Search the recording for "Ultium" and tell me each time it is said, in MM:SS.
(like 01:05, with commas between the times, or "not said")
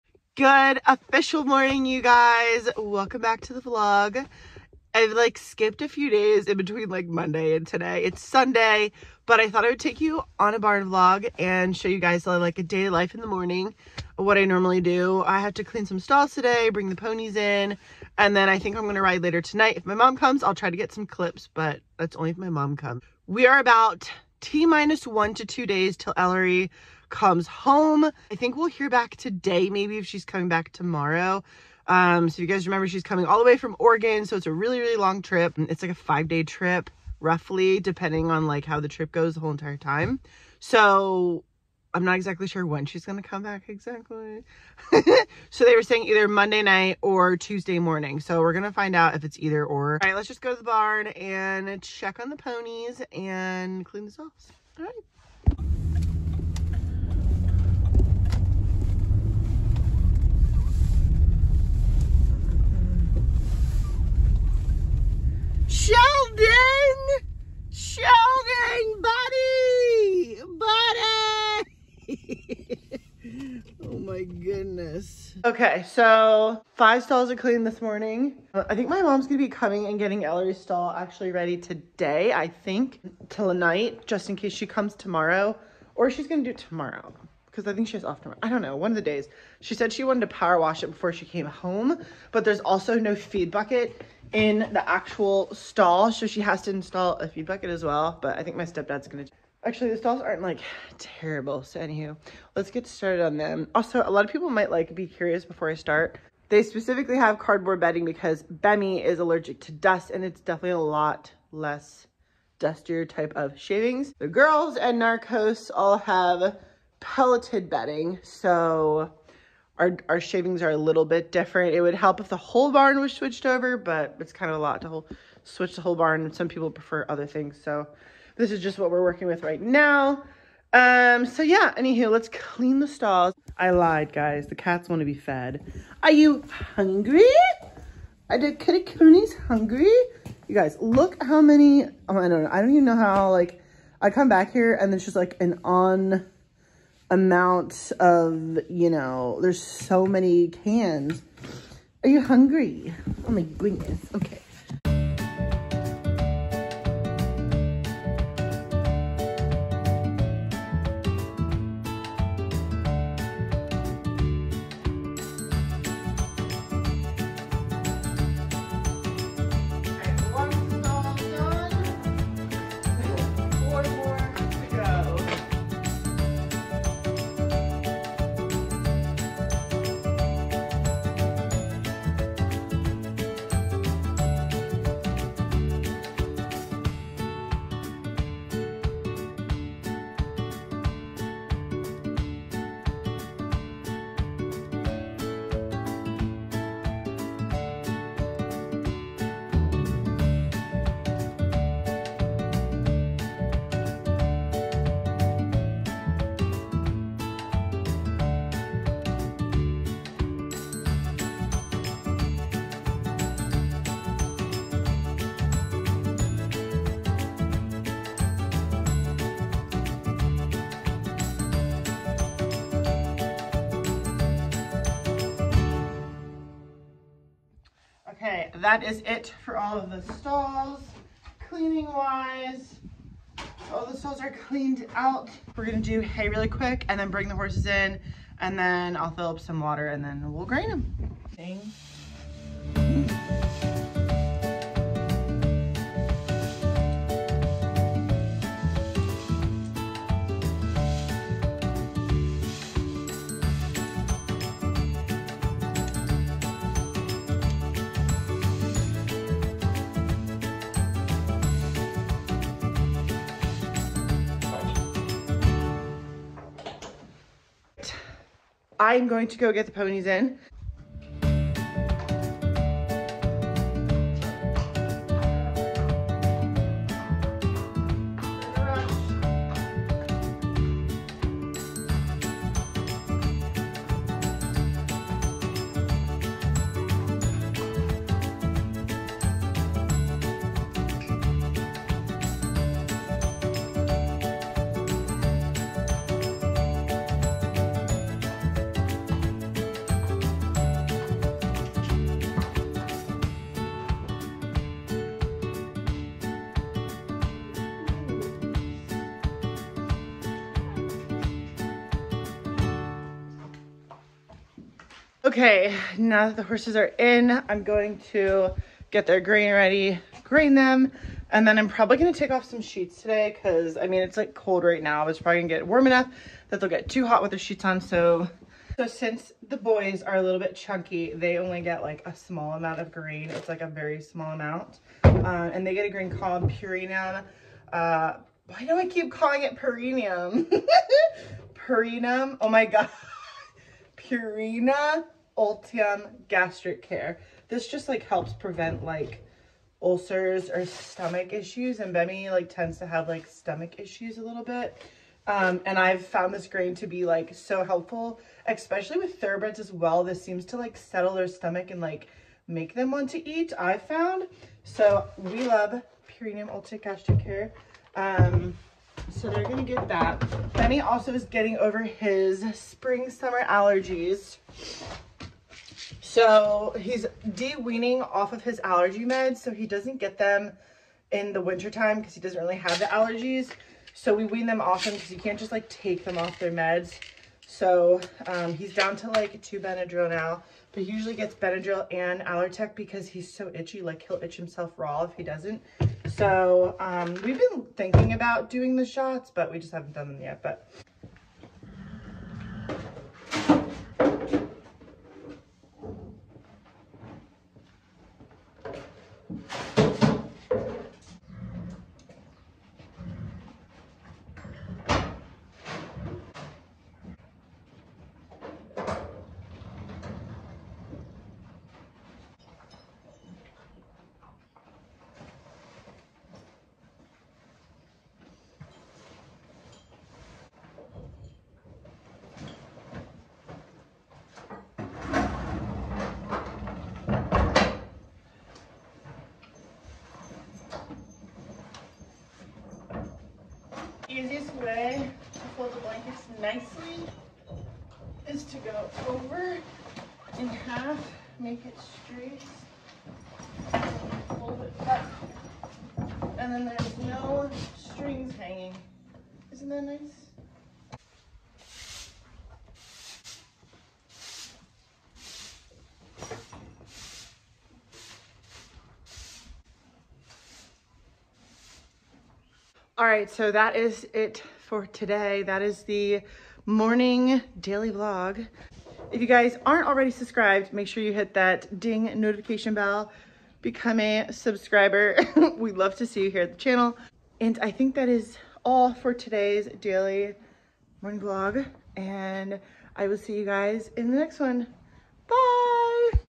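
05:45, 06:06.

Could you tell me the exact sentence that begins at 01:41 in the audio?
So anywho, let's get started on them.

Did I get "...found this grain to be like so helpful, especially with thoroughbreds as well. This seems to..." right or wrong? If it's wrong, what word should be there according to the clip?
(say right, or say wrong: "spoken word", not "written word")
right.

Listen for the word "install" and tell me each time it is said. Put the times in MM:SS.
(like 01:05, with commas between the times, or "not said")
01:36.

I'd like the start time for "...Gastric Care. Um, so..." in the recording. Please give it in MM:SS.
06:06.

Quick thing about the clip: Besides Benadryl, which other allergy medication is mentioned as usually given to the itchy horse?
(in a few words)
Allertech.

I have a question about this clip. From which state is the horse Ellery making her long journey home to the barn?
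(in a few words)
Oregon.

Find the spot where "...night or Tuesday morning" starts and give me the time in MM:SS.
00:46.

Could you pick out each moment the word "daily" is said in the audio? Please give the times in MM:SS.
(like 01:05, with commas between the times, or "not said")
07:57, 08:09.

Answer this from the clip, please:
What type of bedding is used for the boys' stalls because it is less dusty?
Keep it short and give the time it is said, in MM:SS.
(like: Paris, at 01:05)
Cardboard bedding, at 01:47.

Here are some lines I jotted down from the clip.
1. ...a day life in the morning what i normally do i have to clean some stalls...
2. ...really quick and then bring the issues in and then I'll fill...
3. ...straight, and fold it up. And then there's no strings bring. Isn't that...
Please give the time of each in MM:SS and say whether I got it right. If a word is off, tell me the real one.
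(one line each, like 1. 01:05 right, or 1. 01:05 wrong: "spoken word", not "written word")
1. 00:12 right
2. 03:56 wrong: "horses", not "issues"
3. 07:31 wrong: "hanging", not "bring".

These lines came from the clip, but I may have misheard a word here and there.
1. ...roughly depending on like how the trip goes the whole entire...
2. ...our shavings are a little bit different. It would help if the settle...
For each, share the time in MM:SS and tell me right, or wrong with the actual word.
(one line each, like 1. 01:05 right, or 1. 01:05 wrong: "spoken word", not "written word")
1. 00:37 right
2. 02:00 wrong: "whole", not "settle".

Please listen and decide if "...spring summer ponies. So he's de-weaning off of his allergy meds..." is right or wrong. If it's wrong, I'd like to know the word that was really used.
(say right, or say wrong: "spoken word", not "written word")
wrong: "allergies", not "ponies".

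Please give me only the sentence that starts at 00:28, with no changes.
I think we'll hear back today, maybe if she's coming back tomorrow.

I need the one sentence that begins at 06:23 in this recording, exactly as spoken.
So we wean them off him because you can't just like take them off their meds.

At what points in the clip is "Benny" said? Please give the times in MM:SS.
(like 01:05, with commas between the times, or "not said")
06:10.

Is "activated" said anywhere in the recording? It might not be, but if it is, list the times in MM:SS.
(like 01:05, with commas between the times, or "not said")
not said.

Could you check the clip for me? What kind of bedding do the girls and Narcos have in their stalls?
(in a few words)
Pelleted bedding.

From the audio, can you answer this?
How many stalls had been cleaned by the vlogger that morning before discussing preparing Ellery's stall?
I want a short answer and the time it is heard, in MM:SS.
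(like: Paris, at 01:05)
5, at 01:16.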